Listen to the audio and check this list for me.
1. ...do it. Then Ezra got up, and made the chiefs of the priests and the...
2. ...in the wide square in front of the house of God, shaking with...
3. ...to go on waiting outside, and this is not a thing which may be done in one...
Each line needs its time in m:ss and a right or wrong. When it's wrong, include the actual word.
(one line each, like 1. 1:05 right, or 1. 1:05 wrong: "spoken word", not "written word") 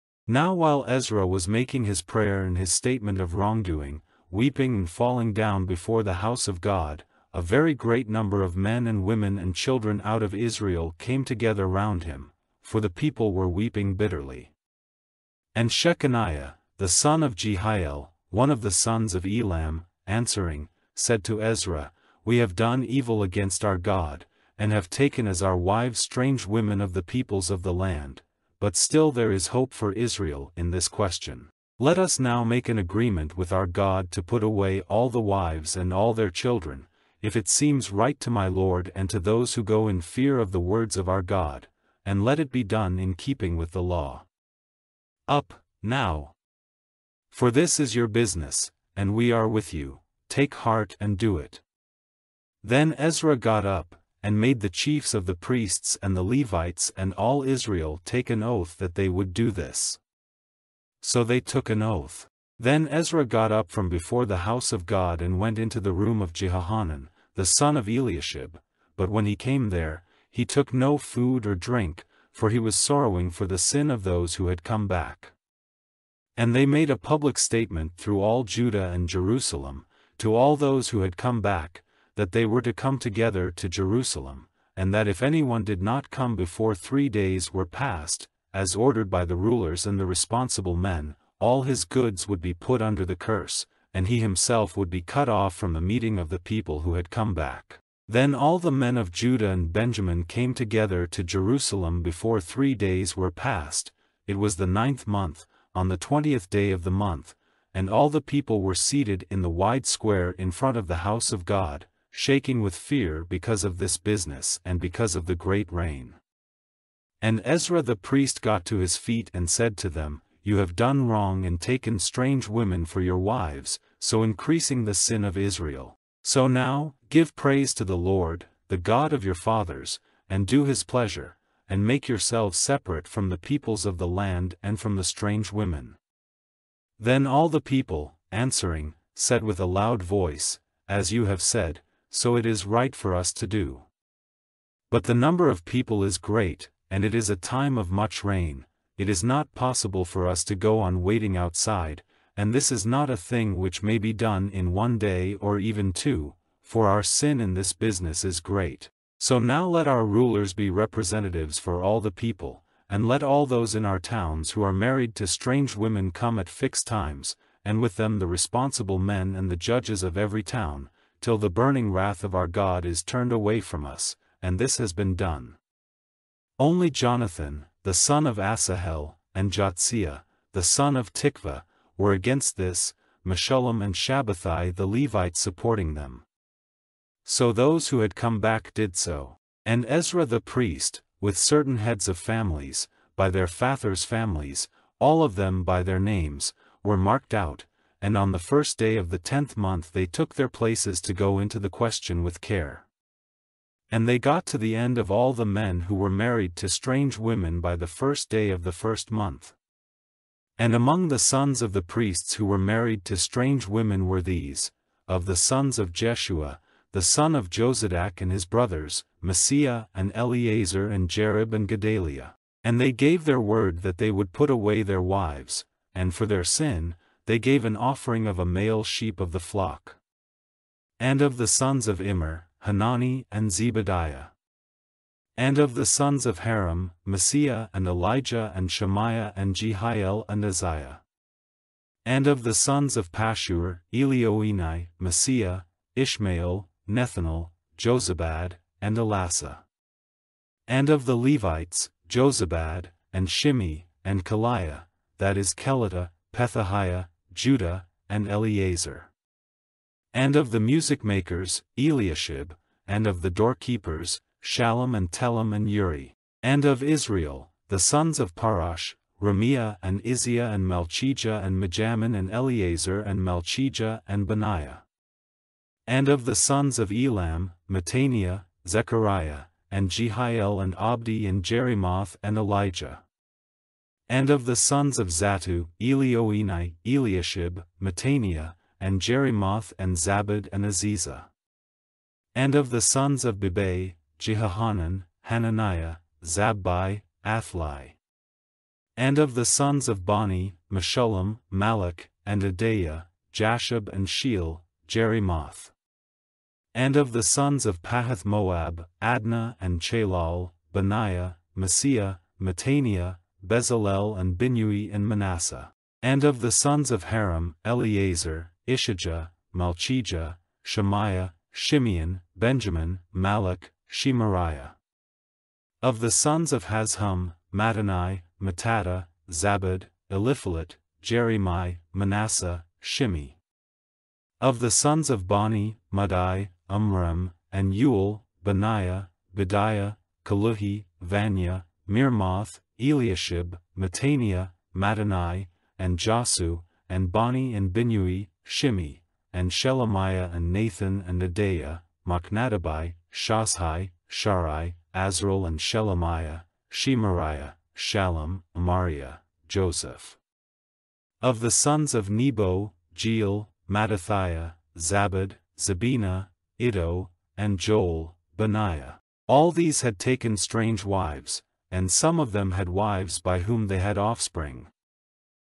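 1. 0:51 right
2. 1:49 right
3. 2:30 right.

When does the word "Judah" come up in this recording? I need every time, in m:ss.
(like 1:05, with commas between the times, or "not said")
1:18, 1:39, 4:17.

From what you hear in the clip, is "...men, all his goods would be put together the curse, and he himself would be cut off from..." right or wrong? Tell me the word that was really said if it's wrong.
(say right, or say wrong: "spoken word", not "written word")
wrong: "under", not "together".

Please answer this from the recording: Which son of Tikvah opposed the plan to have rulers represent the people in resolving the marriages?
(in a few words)
Jahaziah.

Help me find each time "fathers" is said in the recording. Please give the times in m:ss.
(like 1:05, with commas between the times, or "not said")
2:09, 3:13.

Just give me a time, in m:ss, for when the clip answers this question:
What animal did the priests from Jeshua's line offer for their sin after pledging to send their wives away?
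3:48.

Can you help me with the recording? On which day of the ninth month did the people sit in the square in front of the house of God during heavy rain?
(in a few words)
20th.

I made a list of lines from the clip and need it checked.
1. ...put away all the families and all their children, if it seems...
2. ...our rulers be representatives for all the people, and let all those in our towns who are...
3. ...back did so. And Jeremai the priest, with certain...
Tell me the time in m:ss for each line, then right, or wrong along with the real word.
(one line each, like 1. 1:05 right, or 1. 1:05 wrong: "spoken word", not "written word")
1. 0:34 wrong: "wives", not "families"
2. 2:39 right
3. 3:08 wrong: "Ezra", not "Jeremai".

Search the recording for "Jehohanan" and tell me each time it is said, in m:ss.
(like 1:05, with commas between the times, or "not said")
1:06, 4:54.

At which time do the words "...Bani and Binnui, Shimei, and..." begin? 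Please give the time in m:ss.
5:47.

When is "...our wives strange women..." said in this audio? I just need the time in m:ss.
0:25.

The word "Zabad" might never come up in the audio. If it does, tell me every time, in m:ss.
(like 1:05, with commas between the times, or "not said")
4:49, 5:29, 6:04.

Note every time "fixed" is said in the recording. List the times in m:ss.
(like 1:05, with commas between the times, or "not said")
2:46.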